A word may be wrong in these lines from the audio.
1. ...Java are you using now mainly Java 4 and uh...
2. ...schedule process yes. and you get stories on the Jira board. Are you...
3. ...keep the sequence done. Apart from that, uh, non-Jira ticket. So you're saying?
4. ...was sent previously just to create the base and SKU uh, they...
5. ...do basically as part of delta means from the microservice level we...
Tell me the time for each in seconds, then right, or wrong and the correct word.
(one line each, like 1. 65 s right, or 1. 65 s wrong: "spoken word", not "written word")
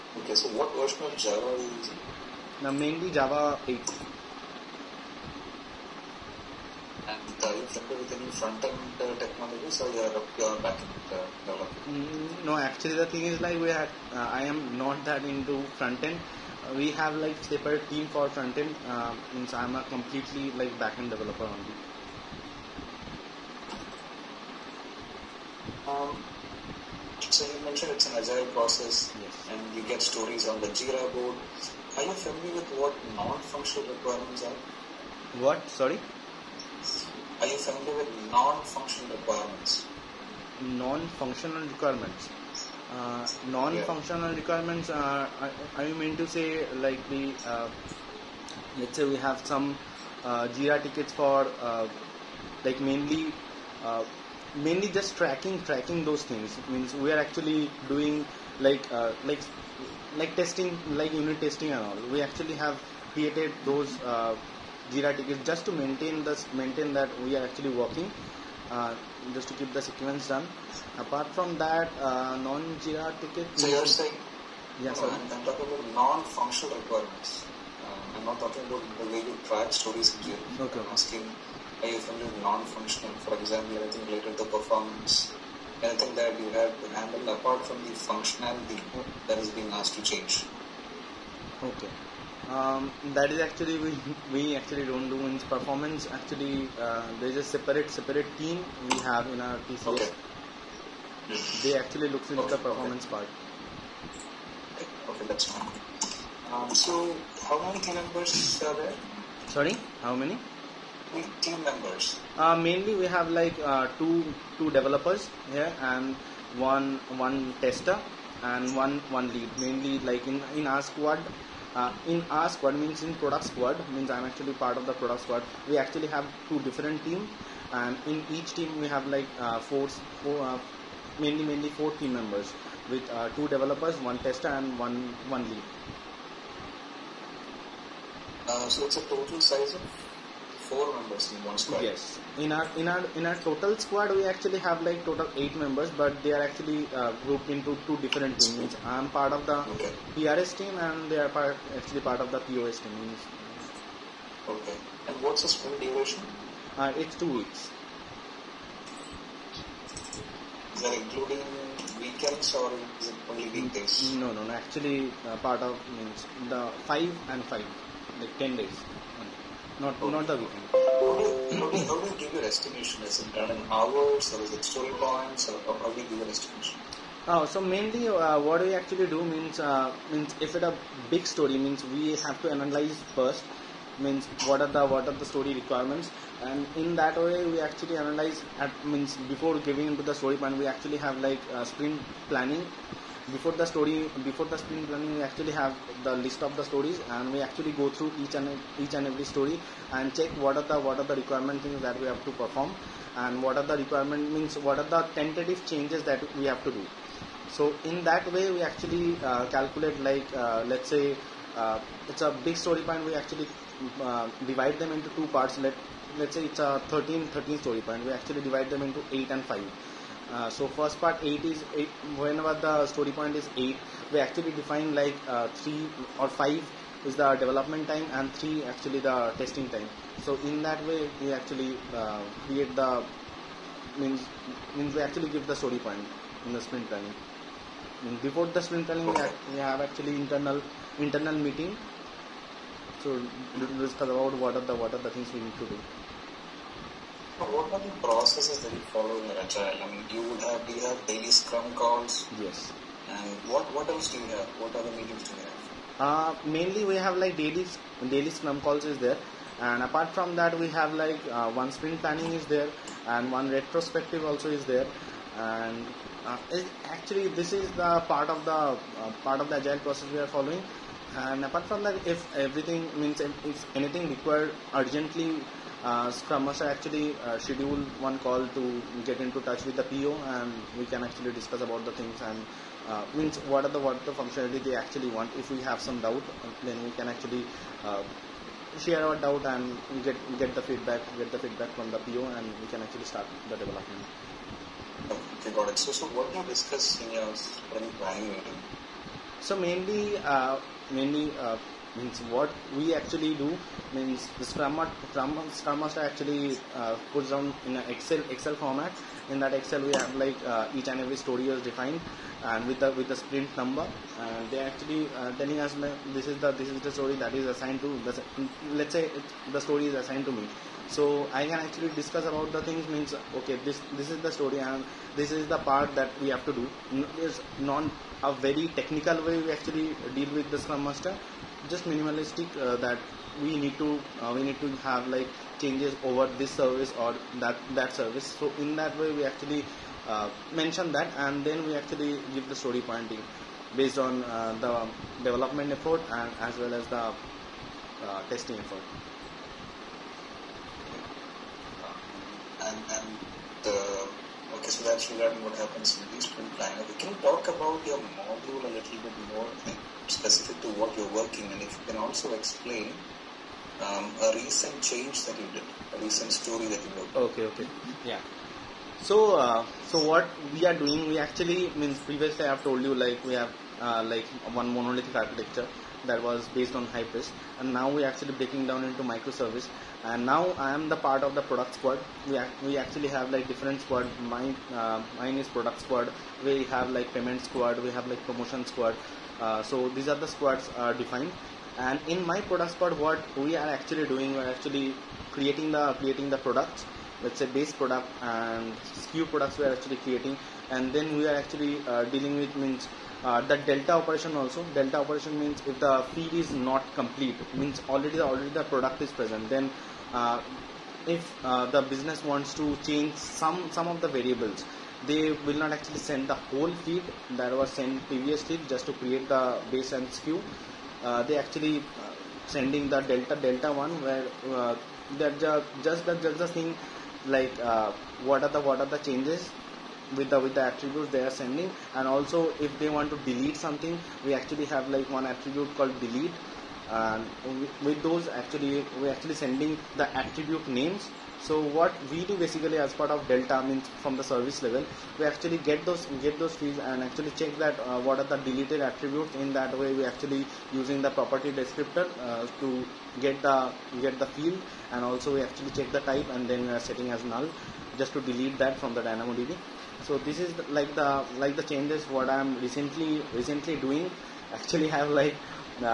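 1. 1 s wrong: "8", not "4"
2. 28 s wrong: "agile", not "schedule"
3. 69 s right
4. 417 s right
5. 442 s wrong: "service", not "microservice".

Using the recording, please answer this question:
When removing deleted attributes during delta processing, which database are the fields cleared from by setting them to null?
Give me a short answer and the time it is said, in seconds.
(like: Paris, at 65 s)
DynamoDB, at 458 s.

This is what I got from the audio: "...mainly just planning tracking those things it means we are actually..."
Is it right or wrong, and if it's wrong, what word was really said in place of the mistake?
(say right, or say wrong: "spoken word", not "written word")
wrong: "tracking", not "planning".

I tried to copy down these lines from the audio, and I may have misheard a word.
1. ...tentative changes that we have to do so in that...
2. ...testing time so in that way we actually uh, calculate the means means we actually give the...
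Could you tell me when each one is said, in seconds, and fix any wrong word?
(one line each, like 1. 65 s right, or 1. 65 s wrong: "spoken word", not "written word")
1. 205 s right
2. 229 s wrong: "create", not "calculate".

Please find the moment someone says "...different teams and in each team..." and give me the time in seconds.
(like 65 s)
126 s.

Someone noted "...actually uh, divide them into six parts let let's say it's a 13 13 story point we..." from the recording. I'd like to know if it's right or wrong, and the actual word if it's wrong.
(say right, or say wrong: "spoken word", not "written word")
wrong: "two", not "six".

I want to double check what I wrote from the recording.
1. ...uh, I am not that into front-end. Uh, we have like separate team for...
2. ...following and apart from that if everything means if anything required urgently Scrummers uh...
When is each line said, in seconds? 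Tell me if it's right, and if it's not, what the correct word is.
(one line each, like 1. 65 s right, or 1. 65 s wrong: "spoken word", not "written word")
1. 13 s right
2. 270 s right.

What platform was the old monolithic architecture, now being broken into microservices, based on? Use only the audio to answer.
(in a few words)
Hybris.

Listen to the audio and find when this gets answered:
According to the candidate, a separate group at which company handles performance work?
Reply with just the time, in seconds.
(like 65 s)
99 s.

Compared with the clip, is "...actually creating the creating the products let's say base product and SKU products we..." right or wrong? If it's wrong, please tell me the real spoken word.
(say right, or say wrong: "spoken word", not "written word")
right.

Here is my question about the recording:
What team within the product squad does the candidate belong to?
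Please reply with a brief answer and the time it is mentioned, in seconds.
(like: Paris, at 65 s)
PRS, at 150 s.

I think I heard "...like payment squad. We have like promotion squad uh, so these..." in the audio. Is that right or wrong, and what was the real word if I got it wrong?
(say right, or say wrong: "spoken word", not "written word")
right.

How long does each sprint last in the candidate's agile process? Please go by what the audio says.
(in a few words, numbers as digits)
2 weeks.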